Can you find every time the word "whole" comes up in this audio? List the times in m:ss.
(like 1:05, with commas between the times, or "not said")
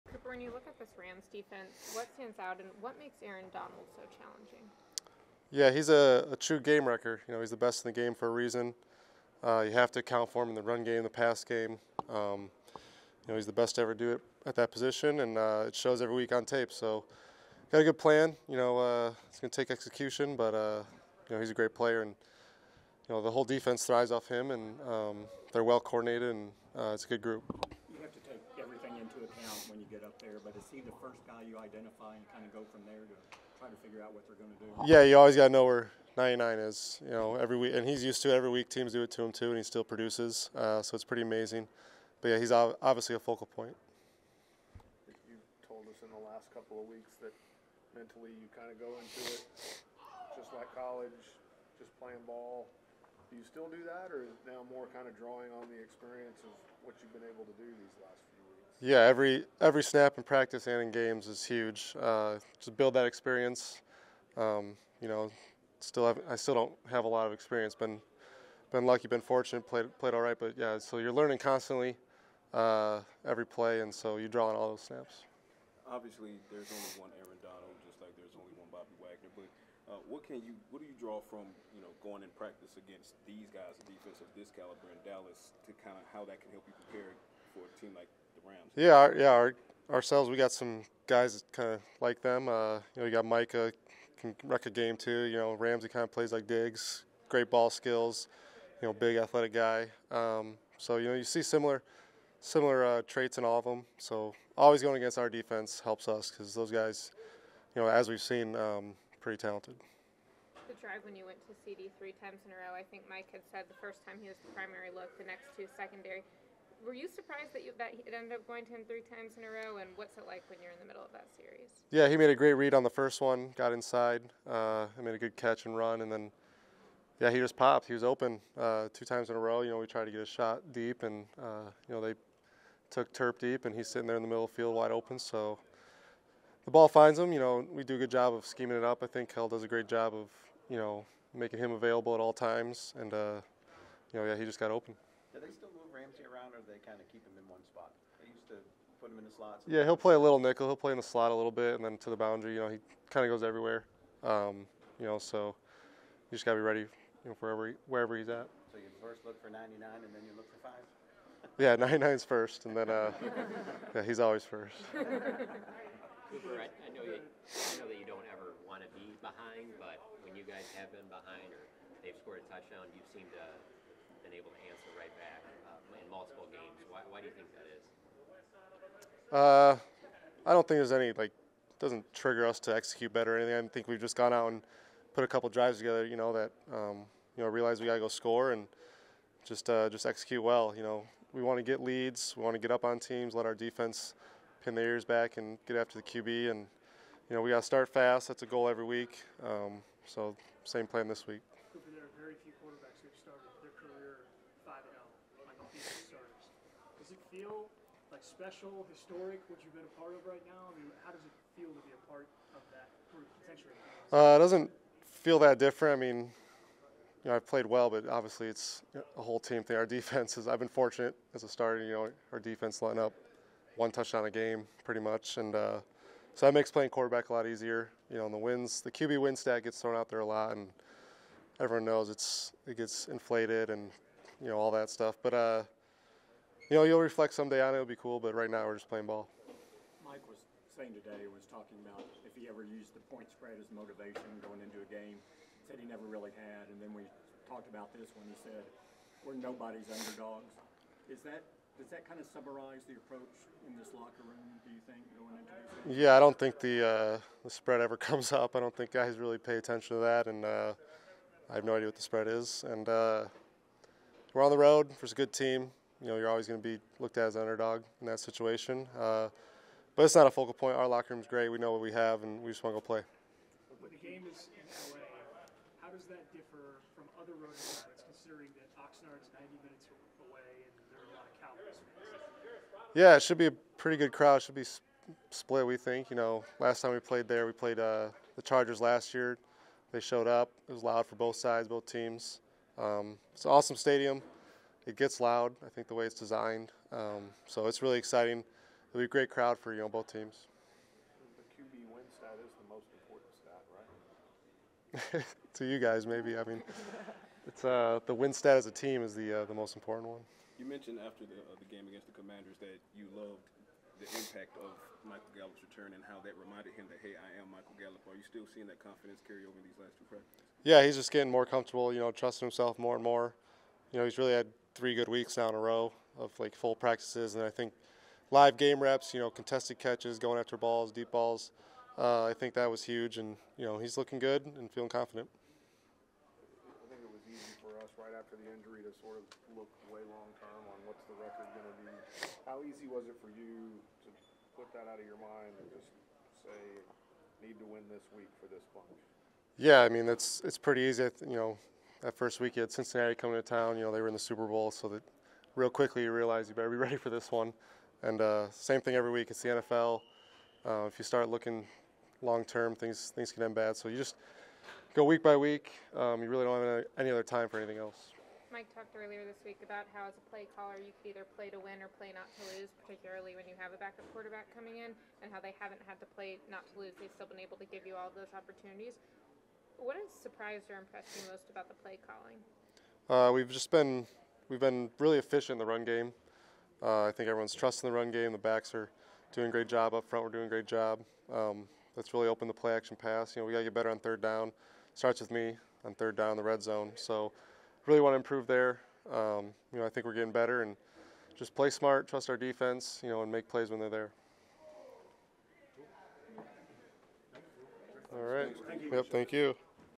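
0:23, 3:39.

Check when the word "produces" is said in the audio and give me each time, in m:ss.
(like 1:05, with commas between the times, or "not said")
0:39.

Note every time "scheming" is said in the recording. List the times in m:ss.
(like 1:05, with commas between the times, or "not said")
2:18.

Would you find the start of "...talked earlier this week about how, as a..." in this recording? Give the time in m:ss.
6:08.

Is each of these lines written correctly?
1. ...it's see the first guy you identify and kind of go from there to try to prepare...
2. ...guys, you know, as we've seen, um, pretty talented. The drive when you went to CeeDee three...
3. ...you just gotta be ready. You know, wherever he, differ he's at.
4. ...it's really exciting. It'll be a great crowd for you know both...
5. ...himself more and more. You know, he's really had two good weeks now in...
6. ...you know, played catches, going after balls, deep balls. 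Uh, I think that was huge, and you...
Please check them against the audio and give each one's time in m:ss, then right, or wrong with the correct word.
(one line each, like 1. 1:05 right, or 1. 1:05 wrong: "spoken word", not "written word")
1. 0:30 wrong: "figure", not "prepare"
2. 1:46 right
3. 2:36 wrong: "wherever", not "differ"
4. 4:57 right
5. 5:22 wrong: "three", not "two"
6. 5:29 wrong: "contested", not "played".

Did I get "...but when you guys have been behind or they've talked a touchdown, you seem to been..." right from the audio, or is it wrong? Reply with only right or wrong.
wrong.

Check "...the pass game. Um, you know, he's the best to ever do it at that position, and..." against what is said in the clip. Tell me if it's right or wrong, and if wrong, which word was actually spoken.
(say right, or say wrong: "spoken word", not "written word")
right.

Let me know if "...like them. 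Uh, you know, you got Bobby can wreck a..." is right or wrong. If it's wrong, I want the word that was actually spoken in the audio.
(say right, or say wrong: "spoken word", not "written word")
wrong: "Micah", not "Bobby".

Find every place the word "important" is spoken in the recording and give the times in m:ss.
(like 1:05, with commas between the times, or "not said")
5:02, 5:09.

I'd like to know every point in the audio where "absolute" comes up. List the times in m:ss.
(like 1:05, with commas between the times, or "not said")
not said.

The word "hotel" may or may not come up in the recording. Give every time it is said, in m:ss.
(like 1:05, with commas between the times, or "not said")
not said.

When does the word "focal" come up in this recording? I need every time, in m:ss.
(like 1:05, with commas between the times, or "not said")
0:43, 4:30.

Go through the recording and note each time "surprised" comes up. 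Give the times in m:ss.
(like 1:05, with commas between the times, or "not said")
1:57, 6:20.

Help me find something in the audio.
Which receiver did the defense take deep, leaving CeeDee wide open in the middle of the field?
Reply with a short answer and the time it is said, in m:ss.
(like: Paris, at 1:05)
Terp, at 2:13.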